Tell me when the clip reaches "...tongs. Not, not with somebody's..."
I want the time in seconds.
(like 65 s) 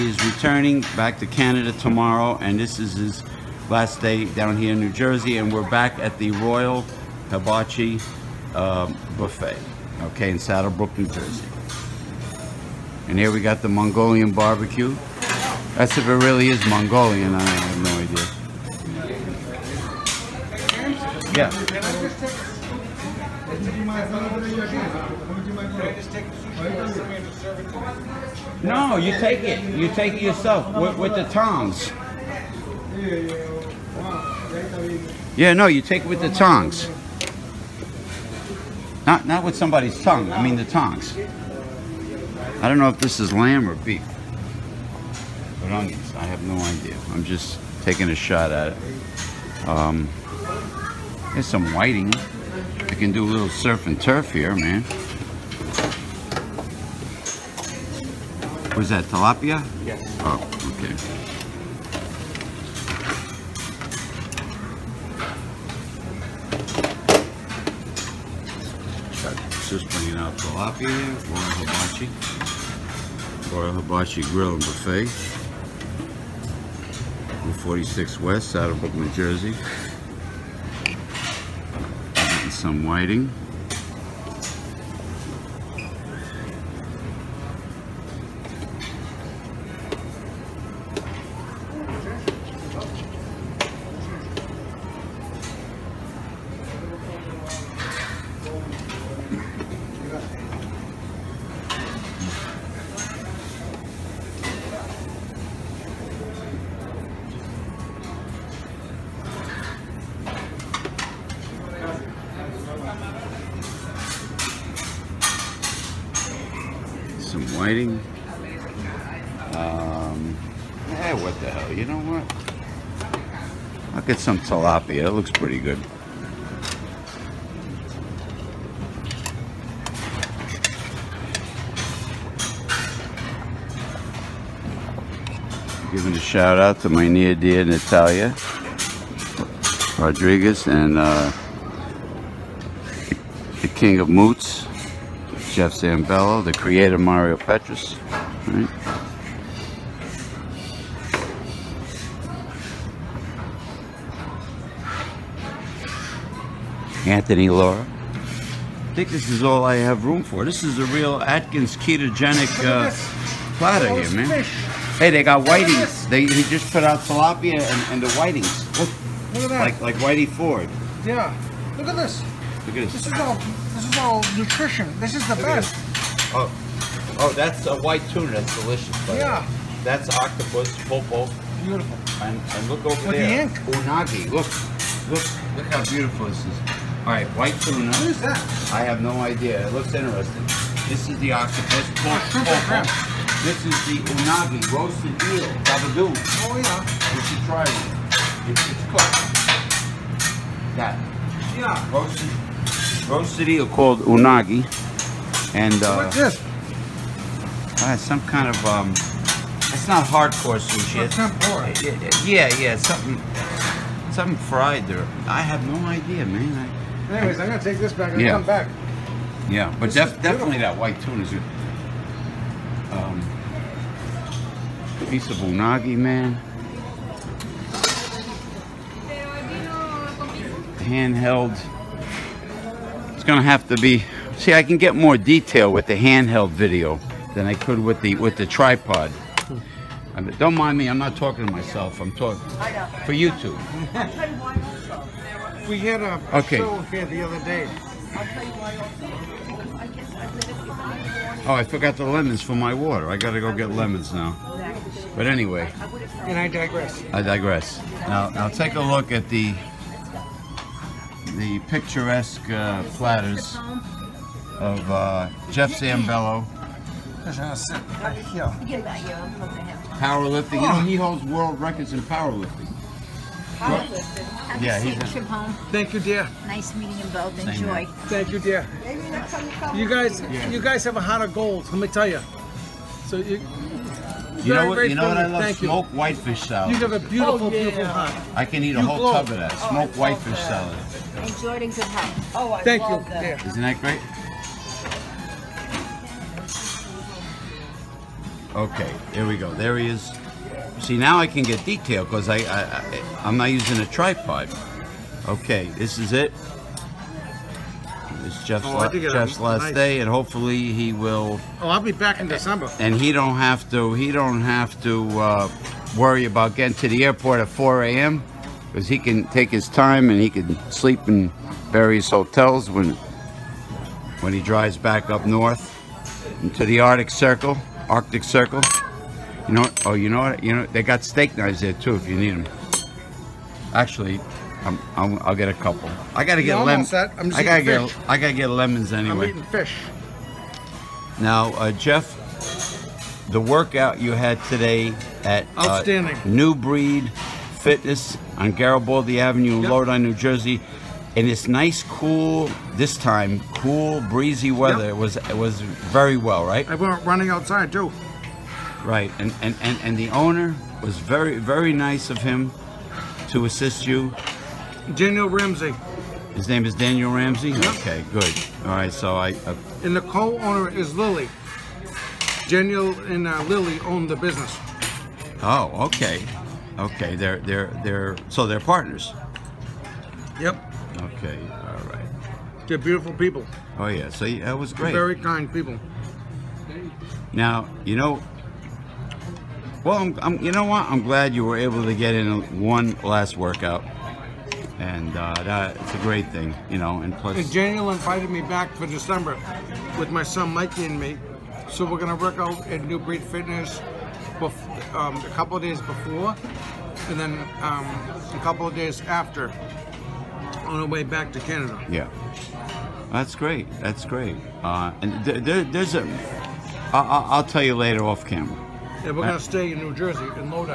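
36 s.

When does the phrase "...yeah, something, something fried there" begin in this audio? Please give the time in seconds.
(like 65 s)
212 s.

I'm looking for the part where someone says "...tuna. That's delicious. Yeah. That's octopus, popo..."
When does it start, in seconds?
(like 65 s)
178 s.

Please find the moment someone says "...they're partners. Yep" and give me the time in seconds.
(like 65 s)
378 s.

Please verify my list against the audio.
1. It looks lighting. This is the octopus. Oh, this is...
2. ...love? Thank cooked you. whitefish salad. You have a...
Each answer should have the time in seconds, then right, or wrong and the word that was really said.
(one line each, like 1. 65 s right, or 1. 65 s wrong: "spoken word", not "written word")
1. 189 s wrong: "interesting", not "lighting"
2. 285 s wrong: "smoked", not "cooked".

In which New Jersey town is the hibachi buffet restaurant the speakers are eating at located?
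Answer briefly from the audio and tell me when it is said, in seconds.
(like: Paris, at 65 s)
Saddle Brook, at 10 s.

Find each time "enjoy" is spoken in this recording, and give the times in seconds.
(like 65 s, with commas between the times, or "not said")
277 s, 291 s.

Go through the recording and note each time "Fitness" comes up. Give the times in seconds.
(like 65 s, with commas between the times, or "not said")
347 s, 403 s.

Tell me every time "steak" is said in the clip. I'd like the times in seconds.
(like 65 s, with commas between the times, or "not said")
331 s.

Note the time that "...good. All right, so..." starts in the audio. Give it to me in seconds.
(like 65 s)
368 s.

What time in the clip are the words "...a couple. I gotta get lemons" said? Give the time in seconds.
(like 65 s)
335 s.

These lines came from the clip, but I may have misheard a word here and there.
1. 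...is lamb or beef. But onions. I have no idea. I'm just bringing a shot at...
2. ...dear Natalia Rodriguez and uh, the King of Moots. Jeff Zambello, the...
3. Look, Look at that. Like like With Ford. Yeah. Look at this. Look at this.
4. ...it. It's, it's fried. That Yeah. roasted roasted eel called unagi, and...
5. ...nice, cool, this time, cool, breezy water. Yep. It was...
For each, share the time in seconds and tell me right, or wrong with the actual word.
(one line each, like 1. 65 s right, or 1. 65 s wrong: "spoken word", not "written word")
1. 43 s wrong: "taking", not "bringing"
2. 137 s right
3. 168 s wrong: "Whitey", not "With"
4. 197 s wrong: "cooked", not "fried"
5. 351 s wrong: "weather", not "water".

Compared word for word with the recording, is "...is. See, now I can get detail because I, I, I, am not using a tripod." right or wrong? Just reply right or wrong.
right.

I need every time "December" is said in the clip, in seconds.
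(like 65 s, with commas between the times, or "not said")
312 s, 398 s.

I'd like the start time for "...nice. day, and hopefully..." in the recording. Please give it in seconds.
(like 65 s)
309 s.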